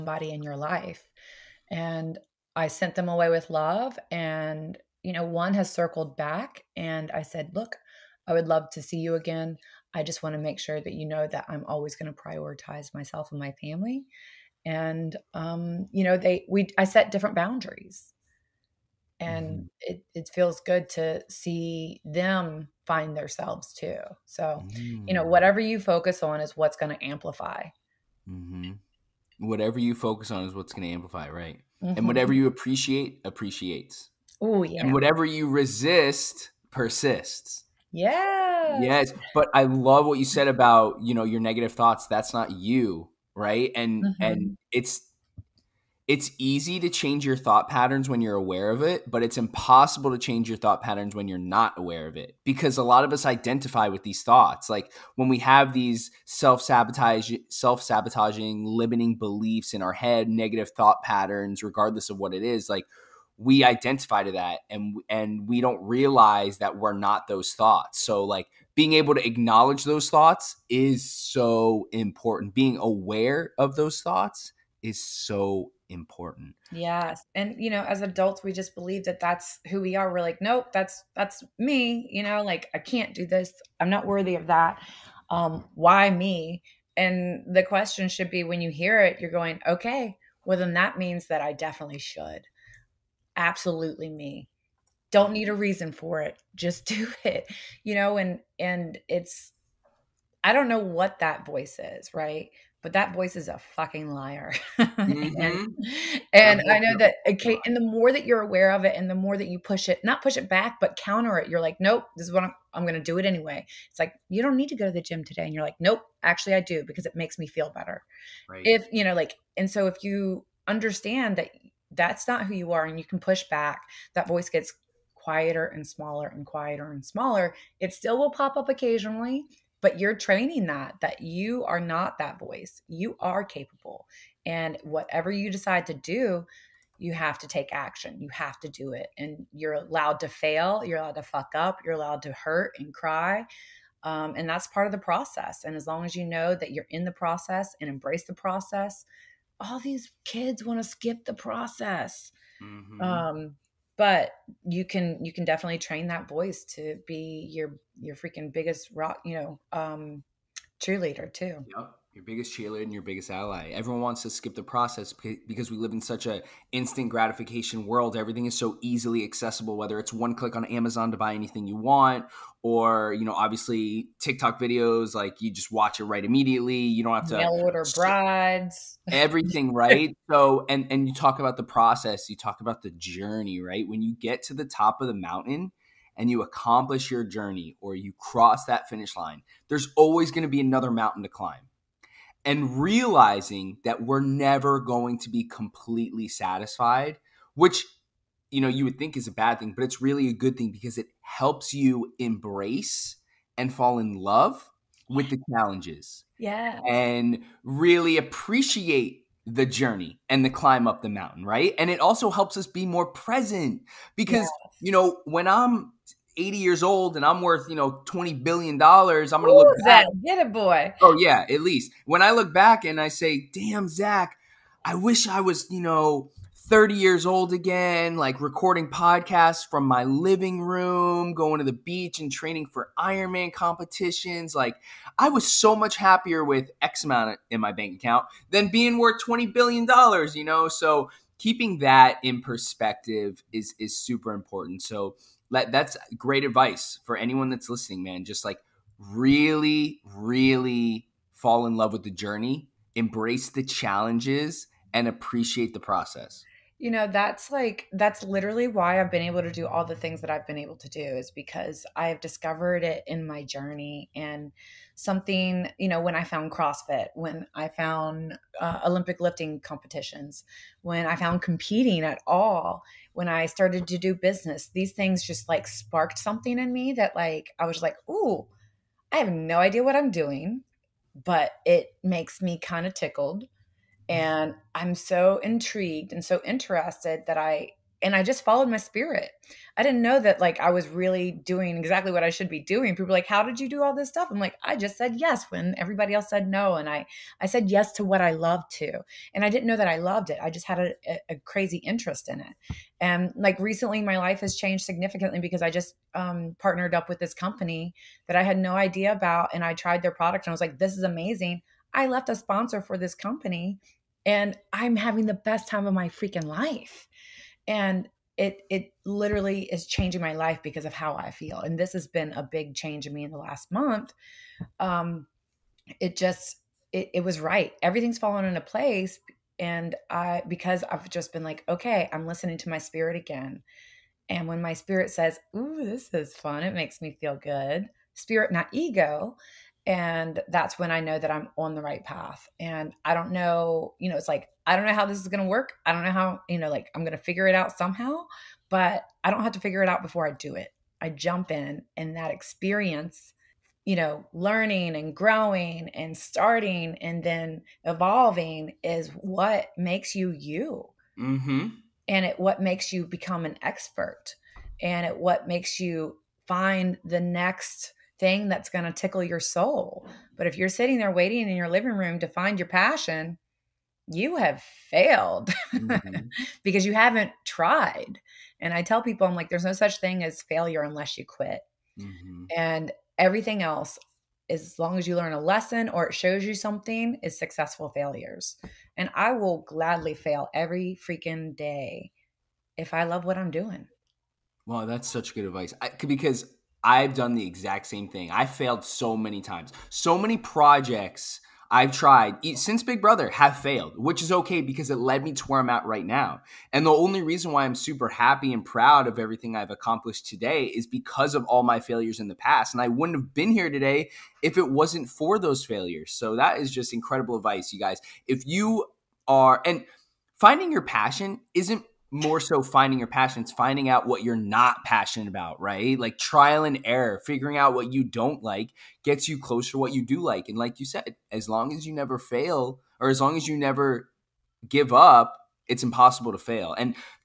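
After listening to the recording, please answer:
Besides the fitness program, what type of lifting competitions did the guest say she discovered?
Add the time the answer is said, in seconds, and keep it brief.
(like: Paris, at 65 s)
Olympic lifting, at 268 s.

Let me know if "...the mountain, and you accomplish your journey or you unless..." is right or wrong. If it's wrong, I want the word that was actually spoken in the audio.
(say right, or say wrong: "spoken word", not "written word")
wrong: "cross", not "unless".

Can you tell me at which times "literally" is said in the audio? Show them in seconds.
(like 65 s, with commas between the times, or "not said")
258 s, 319 s.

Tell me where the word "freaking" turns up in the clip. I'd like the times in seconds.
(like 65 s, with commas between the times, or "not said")
158 s, 316 s, 391 s.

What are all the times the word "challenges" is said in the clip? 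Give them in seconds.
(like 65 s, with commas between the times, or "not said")
205 s, 253 s.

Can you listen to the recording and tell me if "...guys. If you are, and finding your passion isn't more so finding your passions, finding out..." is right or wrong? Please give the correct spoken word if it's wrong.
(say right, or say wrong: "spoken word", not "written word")
right.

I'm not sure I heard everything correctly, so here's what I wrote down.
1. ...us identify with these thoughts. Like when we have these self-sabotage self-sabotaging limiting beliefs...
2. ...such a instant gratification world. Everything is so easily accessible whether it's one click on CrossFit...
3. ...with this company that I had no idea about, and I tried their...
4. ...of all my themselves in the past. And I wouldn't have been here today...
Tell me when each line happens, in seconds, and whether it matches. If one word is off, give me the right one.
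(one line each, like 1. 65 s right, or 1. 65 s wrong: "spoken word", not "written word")
1. 53 s right
2. 165 s wrong: "Amazon", not "CrossFit"
3. 307 s right
4. 411 s wrong: "failures", not "themselves".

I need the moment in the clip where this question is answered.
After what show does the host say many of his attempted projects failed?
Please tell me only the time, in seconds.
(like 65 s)
402 s.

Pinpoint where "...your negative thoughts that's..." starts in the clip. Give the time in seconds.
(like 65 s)
41 s.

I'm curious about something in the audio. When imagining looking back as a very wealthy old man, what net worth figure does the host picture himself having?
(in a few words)
$20 billion.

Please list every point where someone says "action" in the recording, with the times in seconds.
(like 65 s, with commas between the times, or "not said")
137 s.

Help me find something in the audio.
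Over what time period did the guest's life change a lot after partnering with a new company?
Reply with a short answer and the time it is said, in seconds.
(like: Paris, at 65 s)
the last month, at 323 s.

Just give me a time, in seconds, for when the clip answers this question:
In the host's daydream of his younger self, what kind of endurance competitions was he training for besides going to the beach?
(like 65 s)
232 s.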